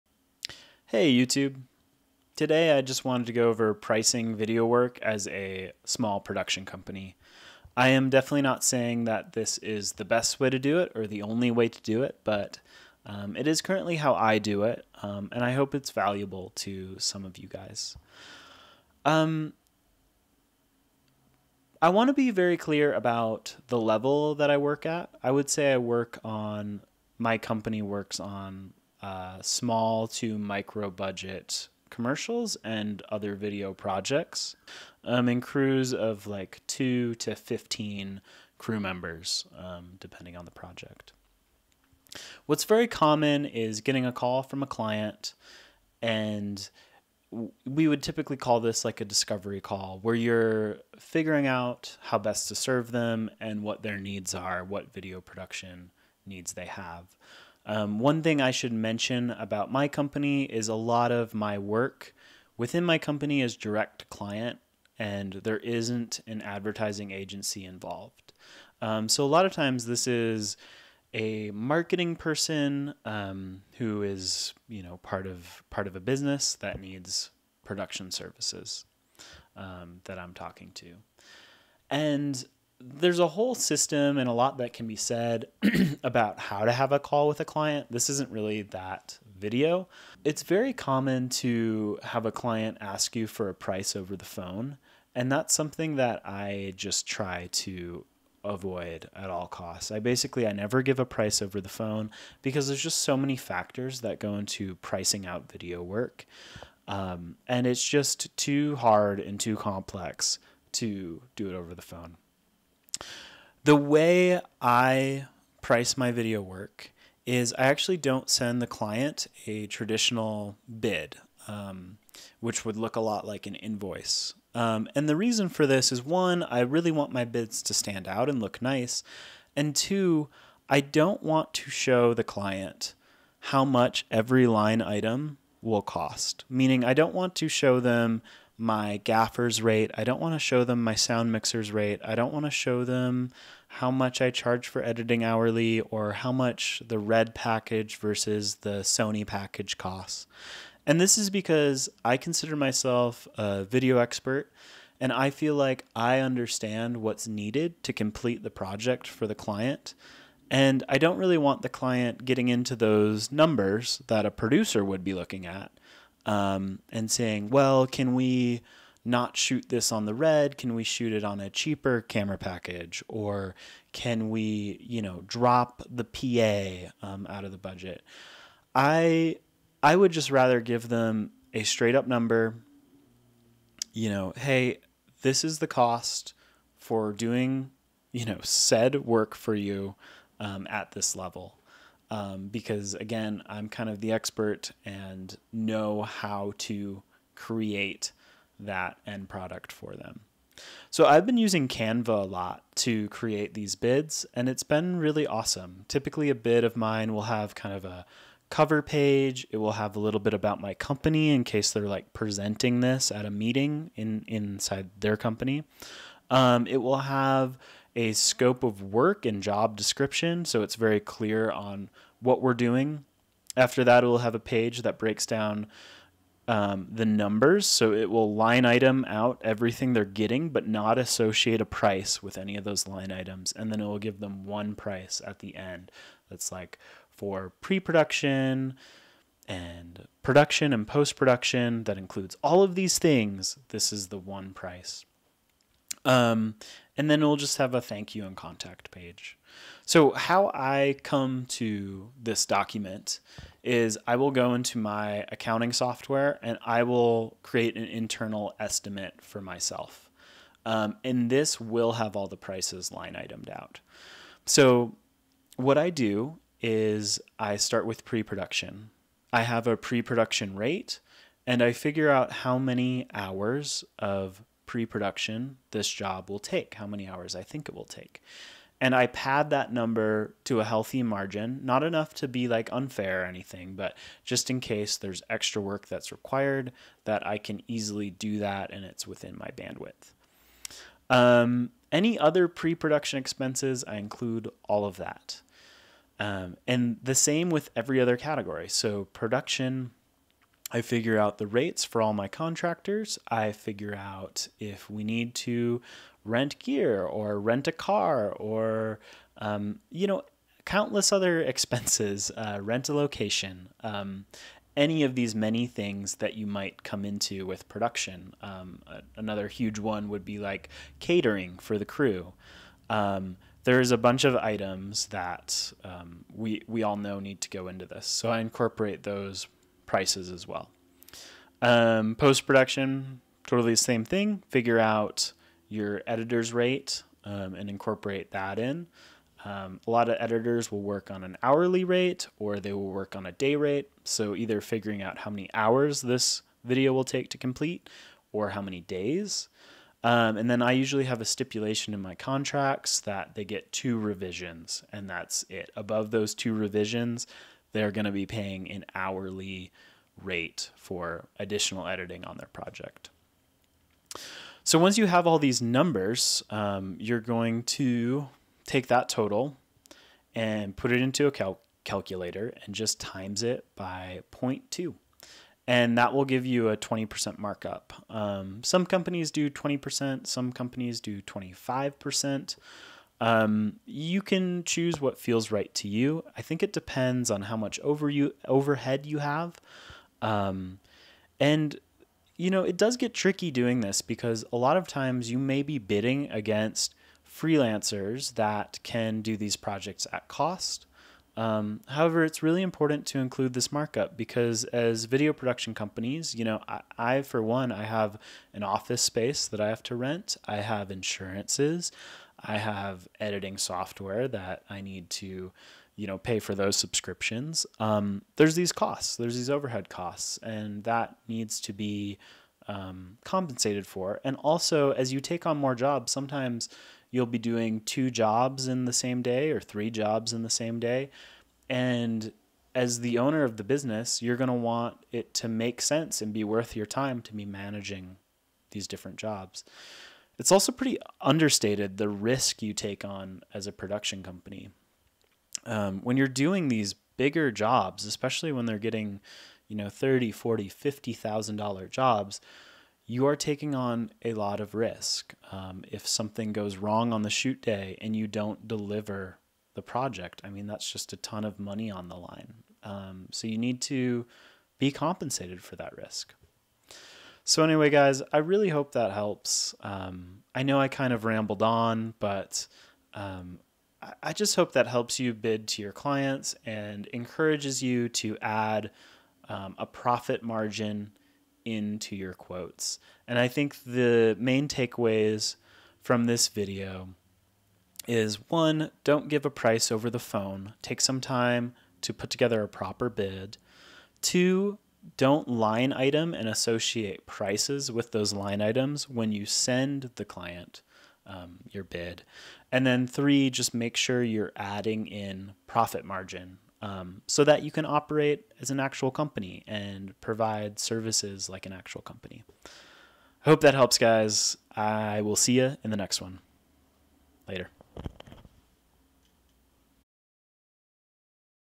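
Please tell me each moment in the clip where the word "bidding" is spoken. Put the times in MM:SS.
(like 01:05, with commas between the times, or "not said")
06:35.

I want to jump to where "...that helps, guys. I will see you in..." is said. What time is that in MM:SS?
08:33.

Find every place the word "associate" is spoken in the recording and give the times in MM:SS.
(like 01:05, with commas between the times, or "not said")
03:50, 08:16.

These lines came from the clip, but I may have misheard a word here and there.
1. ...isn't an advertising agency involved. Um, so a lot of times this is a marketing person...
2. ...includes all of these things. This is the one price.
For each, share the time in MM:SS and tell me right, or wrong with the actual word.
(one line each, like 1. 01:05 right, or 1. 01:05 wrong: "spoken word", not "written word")
1. 01:05 right
2. 04:01 right.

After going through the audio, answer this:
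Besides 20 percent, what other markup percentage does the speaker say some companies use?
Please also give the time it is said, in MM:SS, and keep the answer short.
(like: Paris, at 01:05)
25%, at 06:21.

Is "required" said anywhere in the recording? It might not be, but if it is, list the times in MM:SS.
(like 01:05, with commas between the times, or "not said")
04:46.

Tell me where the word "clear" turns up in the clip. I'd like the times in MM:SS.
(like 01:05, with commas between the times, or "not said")
00:22, 03:40.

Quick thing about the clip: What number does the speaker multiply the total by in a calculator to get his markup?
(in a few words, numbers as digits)
0.2.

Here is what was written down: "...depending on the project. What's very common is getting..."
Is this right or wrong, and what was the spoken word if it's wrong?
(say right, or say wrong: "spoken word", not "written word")
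right.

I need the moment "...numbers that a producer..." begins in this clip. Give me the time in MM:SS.
02:43.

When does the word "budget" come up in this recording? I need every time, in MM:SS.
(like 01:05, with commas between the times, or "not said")
00:30, 02:57.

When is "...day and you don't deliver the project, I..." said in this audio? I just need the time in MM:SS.
07:37.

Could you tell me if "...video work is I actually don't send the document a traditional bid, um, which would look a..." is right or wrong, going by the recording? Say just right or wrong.
wrong.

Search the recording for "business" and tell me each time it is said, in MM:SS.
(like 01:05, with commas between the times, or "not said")
01:15, 07:13.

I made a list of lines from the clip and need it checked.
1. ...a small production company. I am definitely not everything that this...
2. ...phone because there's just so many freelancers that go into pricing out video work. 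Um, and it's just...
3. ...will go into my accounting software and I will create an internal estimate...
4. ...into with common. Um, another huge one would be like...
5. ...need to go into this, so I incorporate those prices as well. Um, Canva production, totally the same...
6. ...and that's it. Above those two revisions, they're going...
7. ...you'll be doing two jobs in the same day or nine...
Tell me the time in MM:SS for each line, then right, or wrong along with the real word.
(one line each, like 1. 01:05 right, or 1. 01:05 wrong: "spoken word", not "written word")
1. 00:05 wrong: "saying", not "everything"
2. 01:41 wrong: "factors", not "freelancers"
3. 04:14 right
4. 05:17 wrong: "production", not "common"
5. 05:27 wrong: "Post", not "Canva"
6. 05:54 right
7. 07:07 wrong: "three", not "nine".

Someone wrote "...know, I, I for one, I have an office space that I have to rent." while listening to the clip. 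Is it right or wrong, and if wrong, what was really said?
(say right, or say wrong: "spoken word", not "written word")
right.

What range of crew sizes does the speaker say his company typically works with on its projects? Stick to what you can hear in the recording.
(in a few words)
2 to 15.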